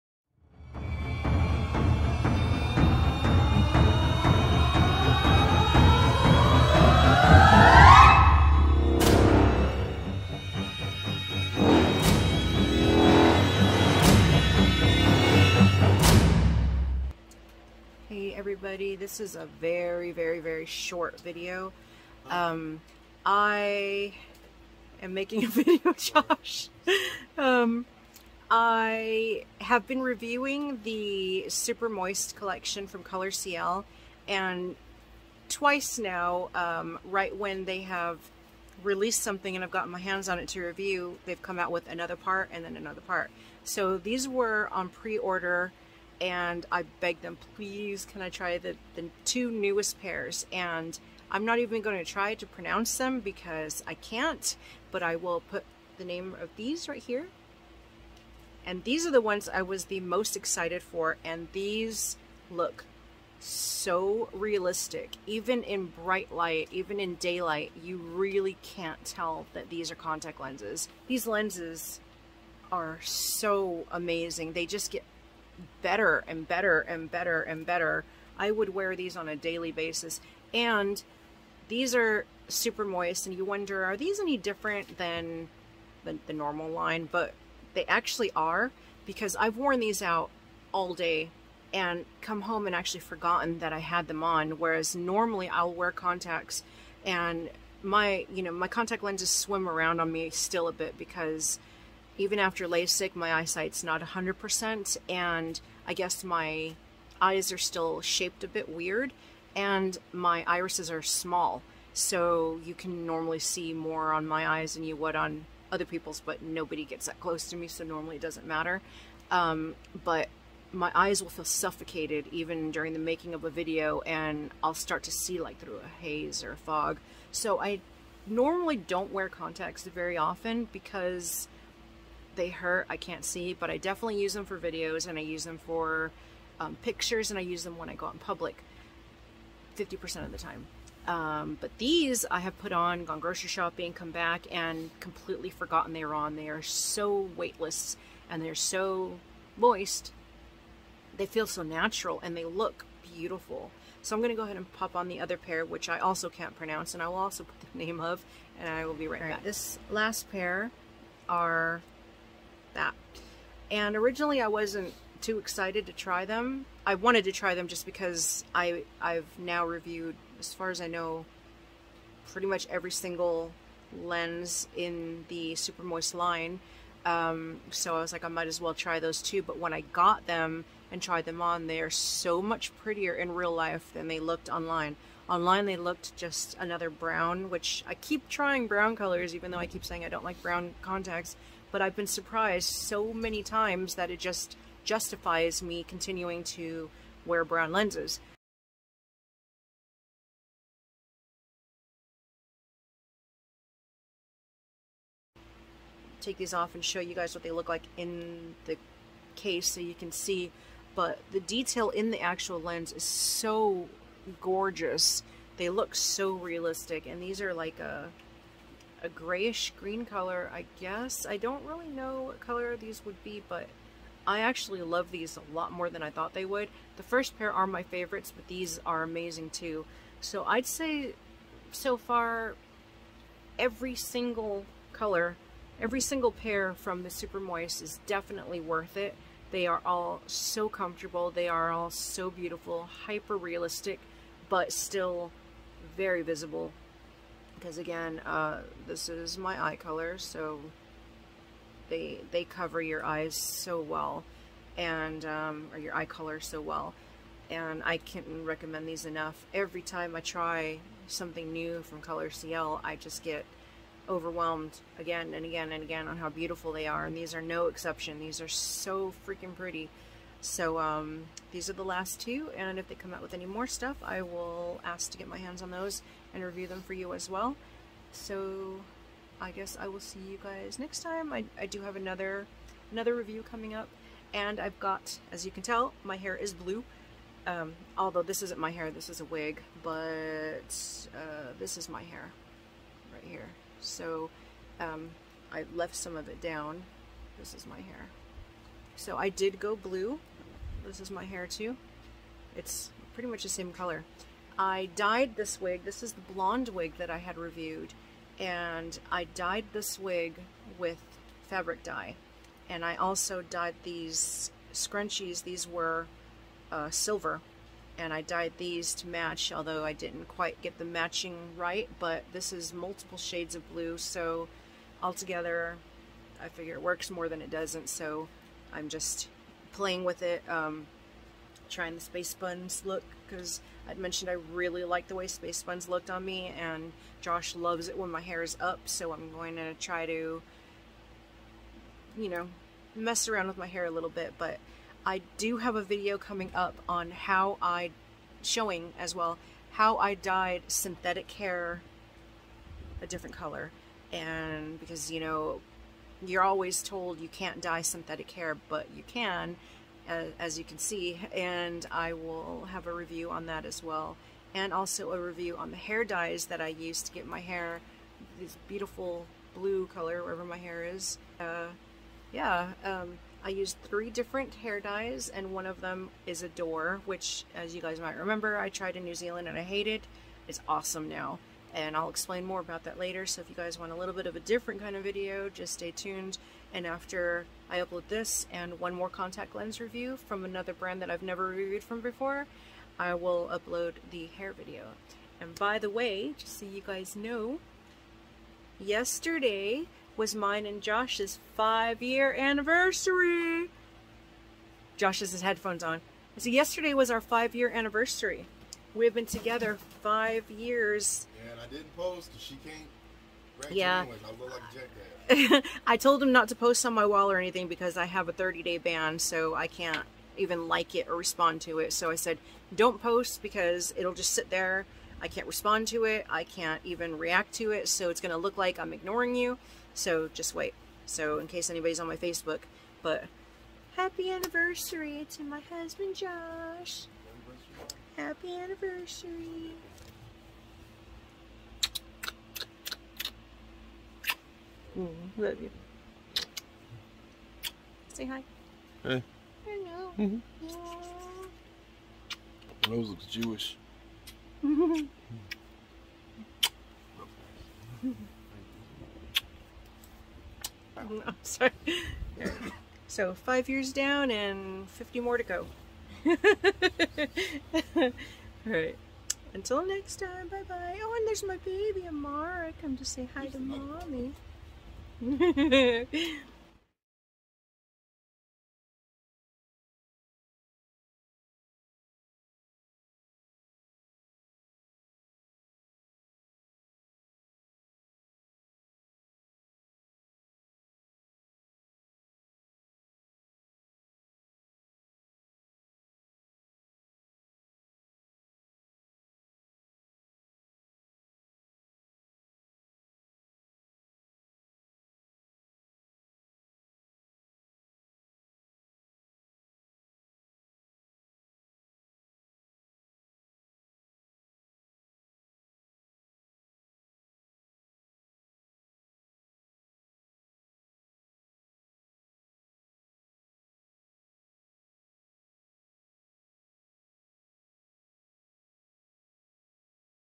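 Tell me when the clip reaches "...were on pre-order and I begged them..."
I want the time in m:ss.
0:44.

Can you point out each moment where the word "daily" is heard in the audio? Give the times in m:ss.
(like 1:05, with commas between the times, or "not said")
1:19.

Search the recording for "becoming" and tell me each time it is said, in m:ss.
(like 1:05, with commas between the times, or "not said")
not said.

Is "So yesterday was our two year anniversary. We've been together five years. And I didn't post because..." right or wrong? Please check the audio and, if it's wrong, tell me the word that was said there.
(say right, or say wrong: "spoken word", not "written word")
wrong: "five", not "two".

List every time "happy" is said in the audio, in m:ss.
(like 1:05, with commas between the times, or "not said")
7:13, 7:18.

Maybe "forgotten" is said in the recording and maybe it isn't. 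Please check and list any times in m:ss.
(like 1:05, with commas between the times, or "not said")
1:32, 2:25.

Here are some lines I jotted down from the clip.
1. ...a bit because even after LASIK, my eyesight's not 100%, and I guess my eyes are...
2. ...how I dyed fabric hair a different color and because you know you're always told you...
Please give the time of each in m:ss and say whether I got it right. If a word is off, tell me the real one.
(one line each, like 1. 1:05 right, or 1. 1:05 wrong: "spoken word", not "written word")
1. 1:40 right
2. 5:49 wrong: "synthetic", not "fabric".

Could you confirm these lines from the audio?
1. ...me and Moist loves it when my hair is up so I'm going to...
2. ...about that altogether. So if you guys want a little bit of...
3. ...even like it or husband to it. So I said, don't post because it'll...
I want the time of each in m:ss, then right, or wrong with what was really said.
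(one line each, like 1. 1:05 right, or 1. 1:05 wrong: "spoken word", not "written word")
1. 5:36 wrong: "Josh", not "Moist"
2. 6:22 wrong: "later", not "altogether"
3. 7:00 wrong: "respond", not "husband".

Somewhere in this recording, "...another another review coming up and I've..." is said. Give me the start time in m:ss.
4:41.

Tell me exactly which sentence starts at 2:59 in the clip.
But when I got them and tried them on, they are so much prettier in real life than they looked online.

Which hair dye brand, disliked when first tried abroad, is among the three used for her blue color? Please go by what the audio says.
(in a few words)
Adore.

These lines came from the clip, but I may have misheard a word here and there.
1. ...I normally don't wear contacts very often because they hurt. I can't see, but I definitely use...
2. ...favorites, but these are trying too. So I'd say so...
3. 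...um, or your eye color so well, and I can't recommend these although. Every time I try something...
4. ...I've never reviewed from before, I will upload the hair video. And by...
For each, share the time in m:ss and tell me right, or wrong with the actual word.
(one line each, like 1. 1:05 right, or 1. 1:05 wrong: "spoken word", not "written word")
1. 2:07 right
2. 3:47 wrong: "amazing", not "trying"
3. 4:15 wrong: "enough", not "although"
4. 6:31 right.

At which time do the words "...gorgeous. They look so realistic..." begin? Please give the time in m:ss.
3:34.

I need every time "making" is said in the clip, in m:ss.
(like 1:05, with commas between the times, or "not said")
0:25, 2:02.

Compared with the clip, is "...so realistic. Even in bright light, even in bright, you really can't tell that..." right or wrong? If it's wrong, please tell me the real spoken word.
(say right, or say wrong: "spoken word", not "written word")
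wrong: "daylight", not "bright".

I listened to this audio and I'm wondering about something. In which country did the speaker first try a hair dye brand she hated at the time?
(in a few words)
New Zealand.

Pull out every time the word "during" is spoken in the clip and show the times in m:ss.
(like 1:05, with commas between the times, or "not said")
2:02.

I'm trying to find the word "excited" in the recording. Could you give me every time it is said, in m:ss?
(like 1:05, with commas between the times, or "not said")
1:00, 2:45.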